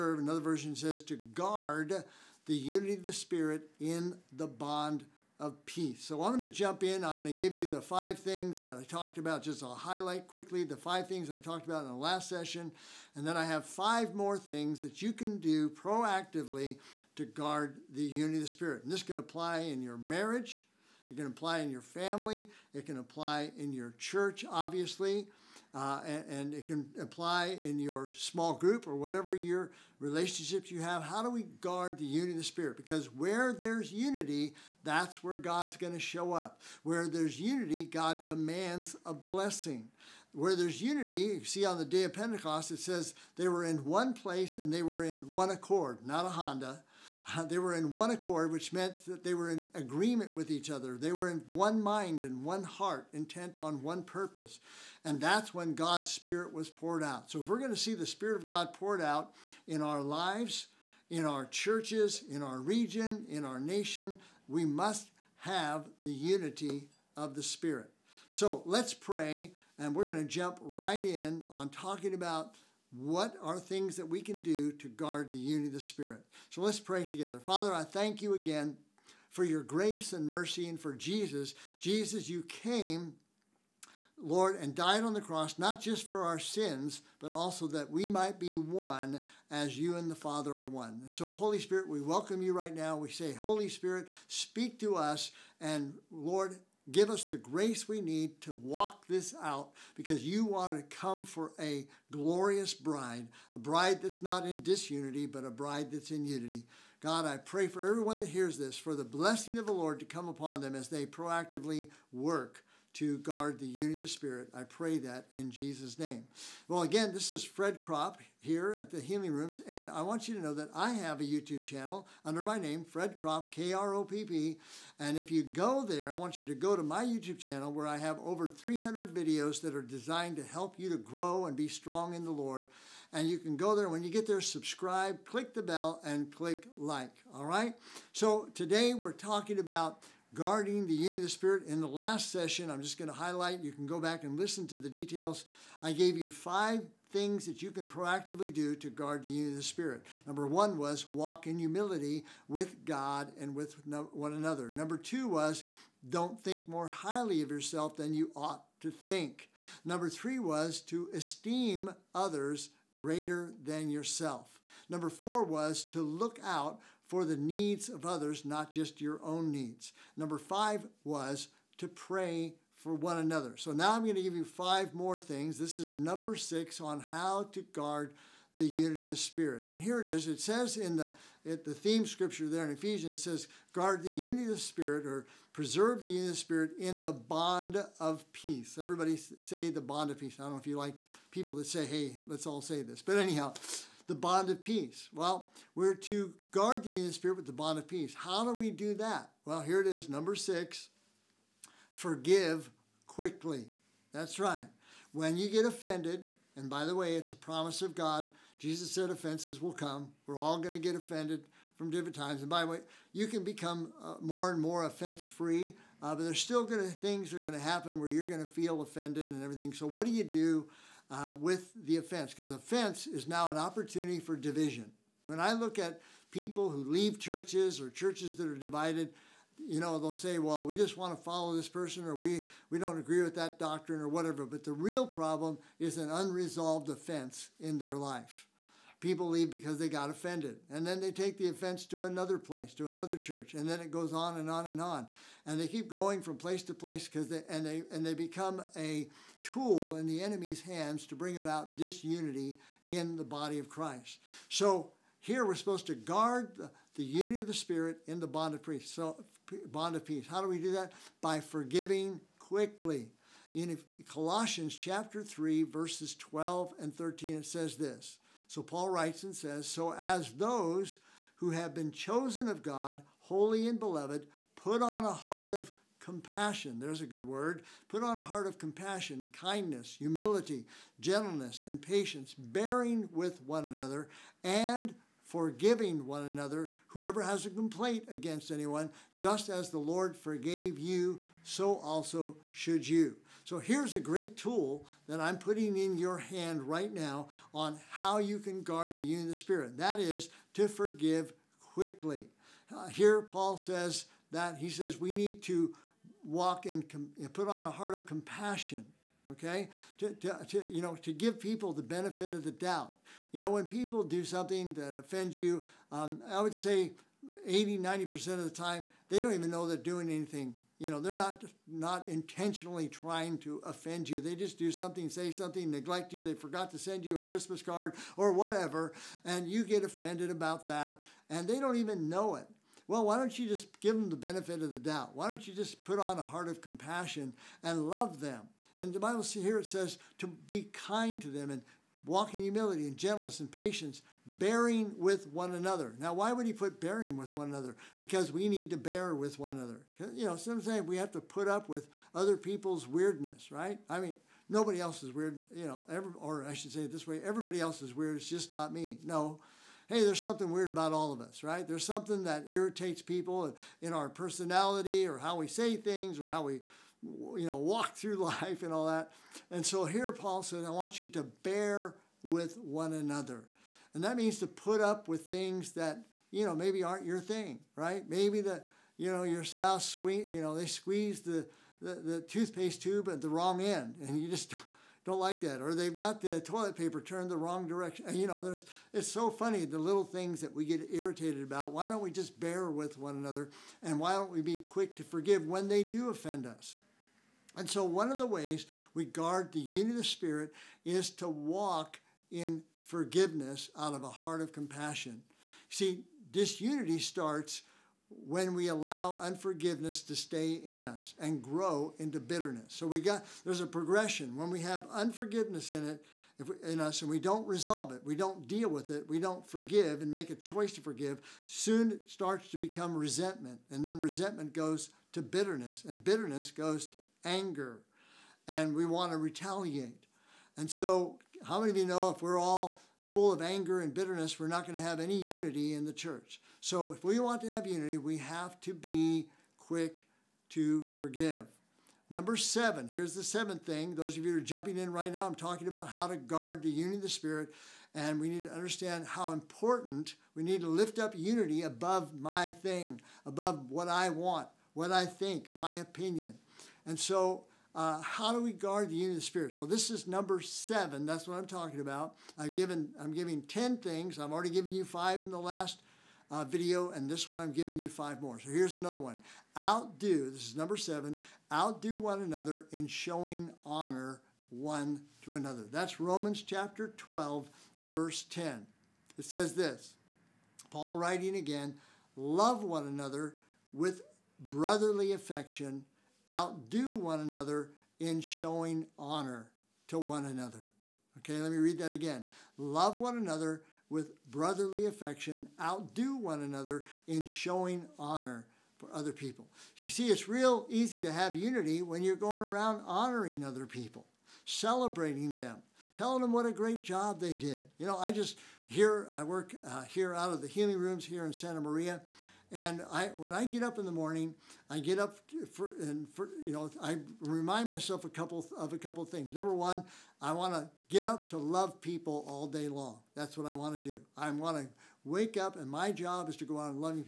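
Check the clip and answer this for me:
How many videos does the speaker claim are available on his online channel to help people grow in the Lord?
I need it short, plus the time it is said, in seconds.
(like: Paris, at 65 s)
over 300, at 128 s.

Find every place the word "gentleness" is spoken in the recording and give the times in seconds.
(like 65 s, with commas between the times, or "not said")
280 s, 342 s.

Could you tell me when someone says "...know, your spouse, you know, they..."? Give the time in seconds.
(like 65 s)
379 s.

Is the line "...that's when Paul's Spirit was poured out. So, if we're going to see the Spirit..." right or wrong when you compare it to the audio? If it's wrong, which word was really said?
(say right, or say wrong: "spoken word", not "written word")
wrong: "God", not "Paul".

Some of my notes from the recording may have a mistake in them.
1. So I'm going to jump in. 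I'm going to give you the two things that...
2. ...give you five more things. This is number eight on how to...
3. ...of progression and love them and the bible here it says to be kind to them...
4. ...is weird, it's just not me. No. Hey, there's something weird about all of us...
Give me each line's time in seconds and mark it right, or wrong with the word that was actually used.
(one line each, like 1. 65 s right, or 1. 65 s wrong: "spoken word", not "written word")
1. 6 s wrong: "five", not "two"
2. 174 s wrong: "six", not "eight"
3. 336 s wrong: "compassion", not "progression"
4. 357 s right.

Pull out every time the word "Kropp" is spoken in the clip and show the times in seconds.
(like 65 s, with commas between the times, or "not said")
117 s, 123 s.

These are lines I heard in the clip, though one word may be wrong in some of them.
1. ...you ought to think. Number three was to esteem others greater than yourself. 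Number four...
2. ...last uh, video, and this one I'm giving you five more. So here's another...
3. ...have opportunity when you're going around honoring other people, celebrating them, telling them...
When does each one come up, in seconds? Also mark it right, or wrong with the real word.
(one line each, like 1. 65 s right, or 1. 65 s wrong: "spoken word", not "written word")
1. 158 s right
2. 465 s right
3. 501 s wrong: "unity", not "opportunity".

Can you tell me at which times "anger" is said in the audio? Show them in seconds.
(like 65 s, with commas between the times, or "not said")
427 s, 433 s.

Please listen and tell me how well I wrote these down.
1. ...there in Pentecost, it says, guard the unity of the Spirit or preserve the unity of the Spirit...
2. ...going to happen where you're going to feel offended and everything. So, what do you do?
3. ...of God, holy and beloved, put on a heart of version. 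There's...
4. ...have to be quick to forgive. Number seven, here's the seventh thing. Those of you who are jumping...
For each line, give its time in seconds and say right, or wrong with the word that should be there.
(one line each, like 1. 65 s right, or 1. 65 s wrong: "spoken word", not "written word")
1. 182 s wrong: "Ephesians", not "Pentecost"
2. 217 s right
3. 272 s wrong: "compassion", not "version"
4. 438 s right.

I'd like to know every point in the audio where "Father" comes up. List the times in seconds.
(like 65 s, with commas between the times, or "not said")
77 s, 90 s.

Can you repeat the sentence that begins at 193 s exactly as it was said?
But anyhow, the bond of peace.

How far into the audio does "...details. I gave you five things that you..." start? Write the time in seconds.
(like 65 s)
144 s.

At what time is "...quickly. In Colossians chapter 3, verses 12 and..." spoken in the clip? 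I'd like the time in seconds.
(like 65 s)
262 s.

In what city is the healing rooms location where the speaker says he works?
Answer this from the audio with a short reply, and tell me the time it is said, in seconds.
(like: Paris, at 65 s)
Santa Maria, at 511 s.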